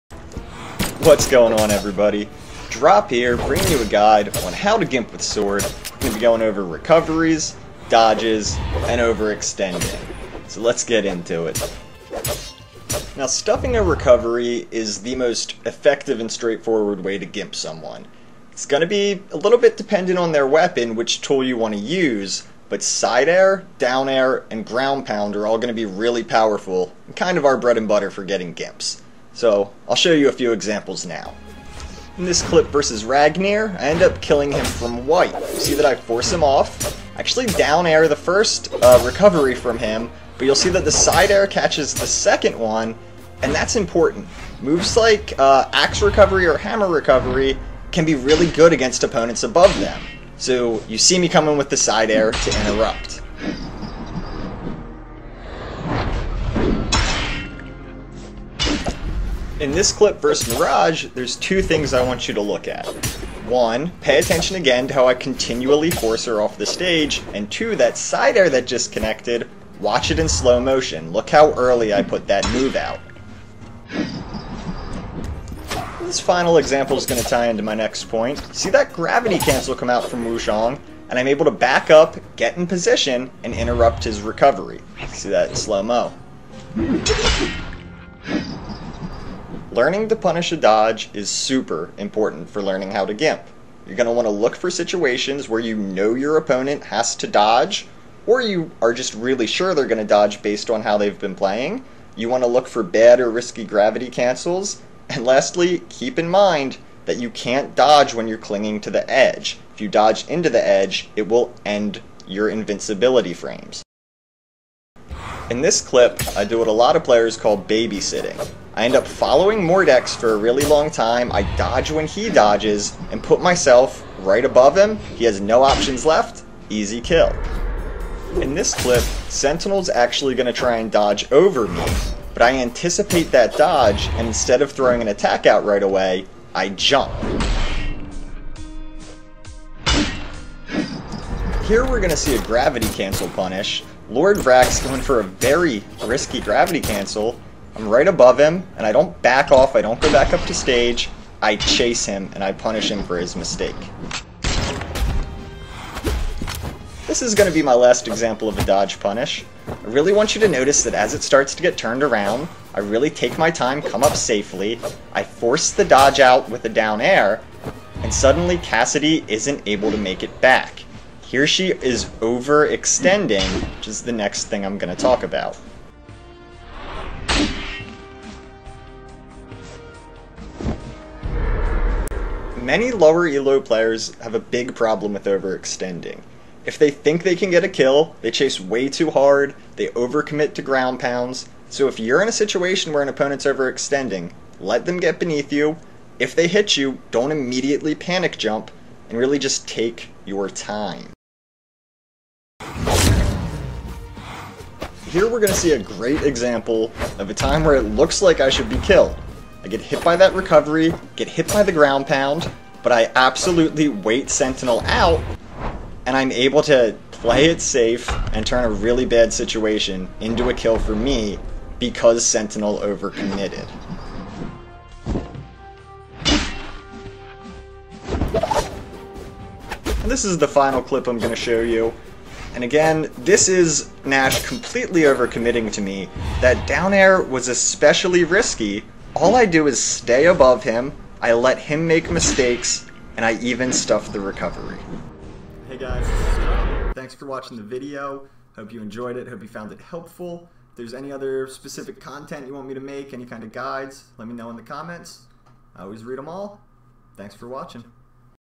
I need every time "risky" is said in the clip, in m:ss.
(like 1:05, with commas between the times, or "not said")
1:43, 2:26, 3:58.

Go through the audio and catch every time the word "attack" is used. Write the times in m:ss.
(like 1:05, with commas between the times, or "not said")
2:15.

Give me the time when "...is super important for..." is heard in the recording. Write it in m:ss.
1:31.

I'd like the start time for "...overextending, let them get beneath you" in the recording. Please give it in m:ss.
3:13.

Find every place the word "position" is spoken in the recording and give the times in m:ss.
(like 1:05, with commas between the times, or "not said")
1:22.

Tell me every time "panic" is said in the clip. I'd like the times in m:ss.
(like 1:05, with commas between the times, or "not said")
3:17.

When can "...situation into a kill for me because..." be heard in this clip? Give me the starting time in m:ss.
3:39.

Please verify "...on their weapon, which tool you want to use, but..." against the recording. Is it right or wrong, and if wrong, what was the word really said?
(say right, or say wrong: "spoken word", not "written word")
right.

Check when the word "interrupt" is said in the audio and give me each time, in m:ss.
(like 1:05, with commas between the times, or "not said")
0:52, 1:23.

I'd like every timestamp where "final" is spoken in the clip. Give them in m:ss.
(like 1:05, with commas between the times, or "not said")
1:16, 3:50.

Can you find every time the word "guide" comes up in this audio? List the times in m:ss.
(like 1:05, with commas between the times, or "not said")
0:03, 4:13.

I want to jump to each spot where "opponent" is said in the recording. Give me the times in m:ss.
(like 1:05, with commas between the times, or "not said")
0:49, 1:36, 3:13.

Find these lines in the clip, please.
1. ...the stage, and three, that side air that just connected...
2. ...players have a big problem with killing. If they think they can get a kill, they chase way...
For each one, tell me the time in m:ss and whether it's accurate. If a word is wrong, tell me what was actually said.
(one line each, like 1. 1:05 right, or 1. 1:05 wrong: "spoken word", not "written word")
1. 1:06 wrong: "two", not "three"
2. 3:03 wrong: "overextending", not "killing".